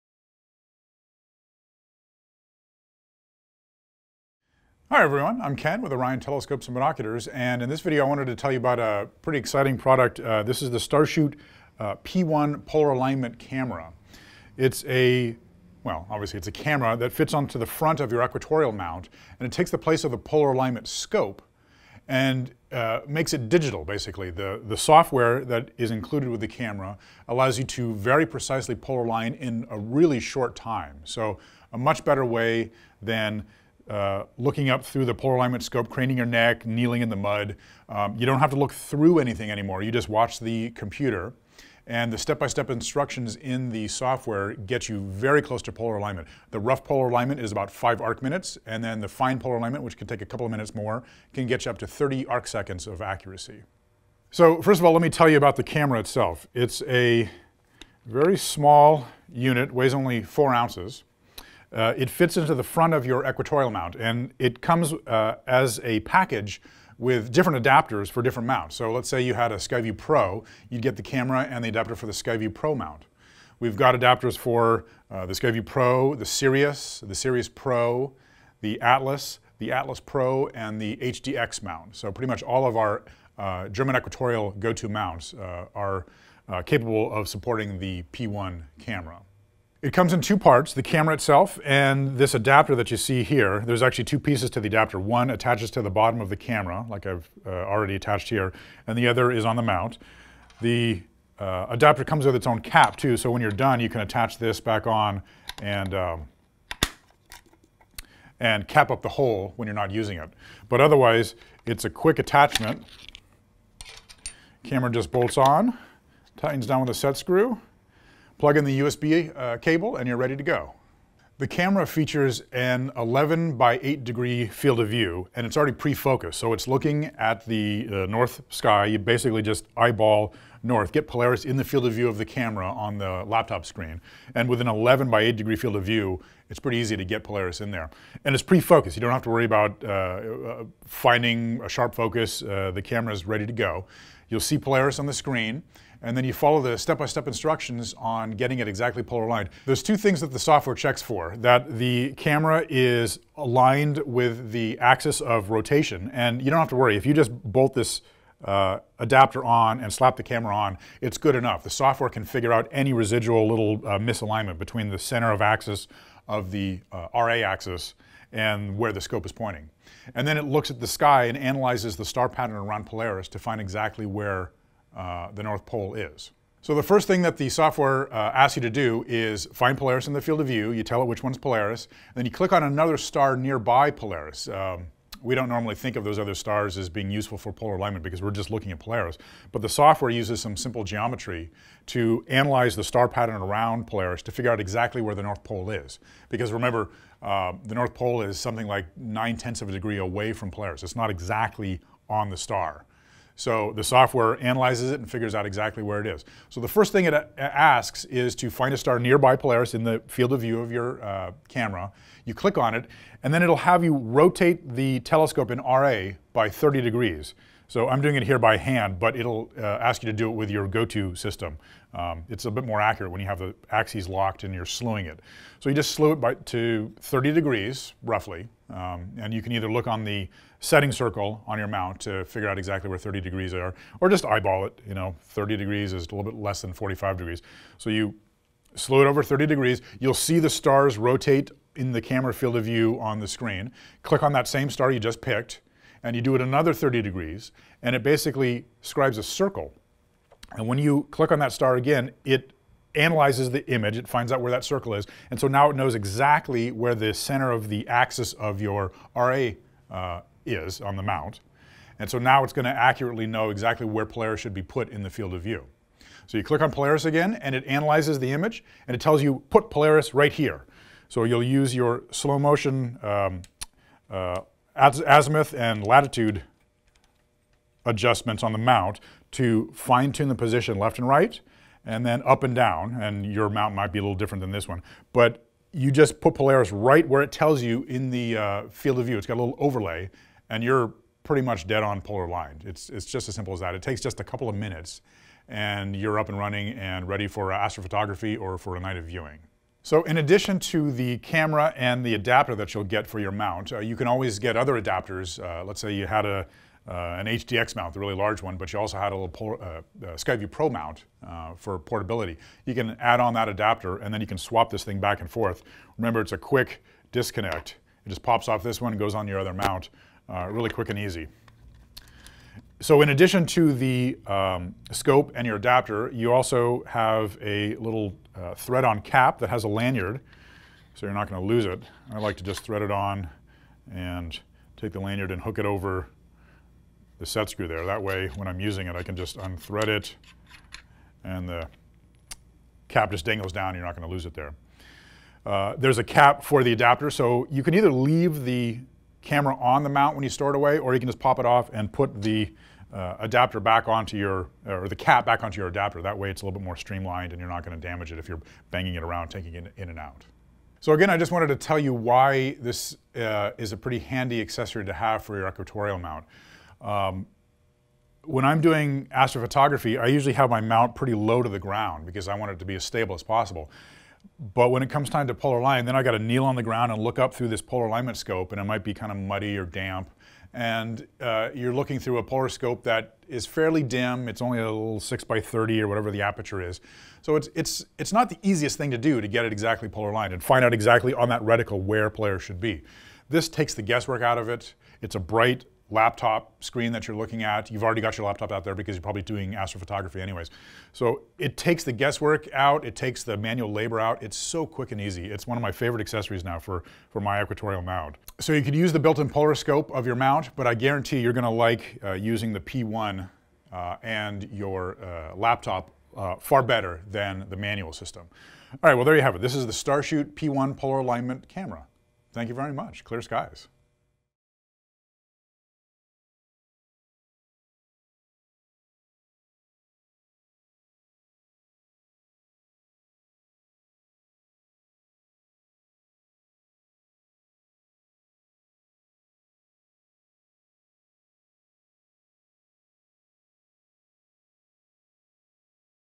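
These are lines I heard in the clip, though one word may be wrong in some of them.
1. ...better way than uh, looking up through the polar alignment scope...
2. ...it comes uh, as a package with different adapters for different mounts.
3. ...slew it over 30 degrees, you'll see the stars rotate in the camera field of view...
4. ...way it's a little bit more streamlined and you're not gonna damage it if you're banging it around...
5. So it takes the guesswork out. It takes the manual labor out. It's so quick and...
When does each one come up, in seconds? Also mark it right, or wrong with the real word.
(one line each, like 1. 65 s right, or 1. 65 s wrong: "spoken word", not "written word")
1. 32 s right
2. 64 s right
3. 238 s right
4. 356 s right
5. 400 s right.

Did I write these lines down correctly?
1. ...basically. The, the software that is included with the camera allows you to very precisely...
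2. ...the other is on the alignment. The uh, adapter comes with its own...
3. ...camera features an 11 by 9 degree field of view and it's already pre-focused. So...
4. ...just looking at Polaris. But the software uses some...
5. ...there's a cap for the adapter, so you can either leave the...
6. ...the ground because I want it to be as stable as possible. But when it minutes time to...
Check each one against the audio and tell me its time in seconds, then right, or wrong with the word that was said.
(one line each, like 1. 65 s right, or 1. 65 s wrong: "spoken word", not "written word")
1. 23 s right
2. 98 s wrong: "mount", not "alignment"
3. 121 s wrong: "8", not "9"
4. 188 s right
5. 345 s right
6. 371 s wrong: "comes", not "minutes".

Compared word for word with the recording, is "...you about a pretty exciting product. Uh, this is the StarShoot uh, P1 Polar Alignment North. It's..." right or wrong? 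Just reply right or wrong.
wrong.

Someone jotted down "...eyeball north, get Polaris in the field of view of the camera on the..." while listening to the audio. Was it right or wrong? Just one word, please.
right.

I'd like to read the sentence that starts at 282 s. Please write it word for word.
And your mount might be a little different than this one.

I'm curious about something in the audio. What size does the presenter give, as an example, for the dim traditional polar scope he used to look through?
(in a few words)
6x30.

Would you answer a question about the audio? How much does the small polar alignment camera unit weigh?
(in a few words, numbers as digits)
4 ounces.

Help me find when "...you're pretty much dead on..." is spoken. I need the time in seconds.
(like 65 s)
290 s.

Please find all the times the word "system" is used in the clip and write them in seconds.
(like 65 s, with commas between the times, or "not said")
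221 s, 417 s.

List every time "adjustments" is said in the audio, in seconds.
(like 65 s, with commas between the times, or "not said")
277 s.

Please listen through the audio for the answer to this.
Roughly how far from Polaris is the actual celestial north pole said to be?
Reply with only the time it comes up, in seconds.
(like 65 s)
198 s.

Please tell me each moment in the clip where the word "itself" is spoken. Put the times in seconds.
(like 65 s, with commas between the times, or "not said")
55 s, 91 s.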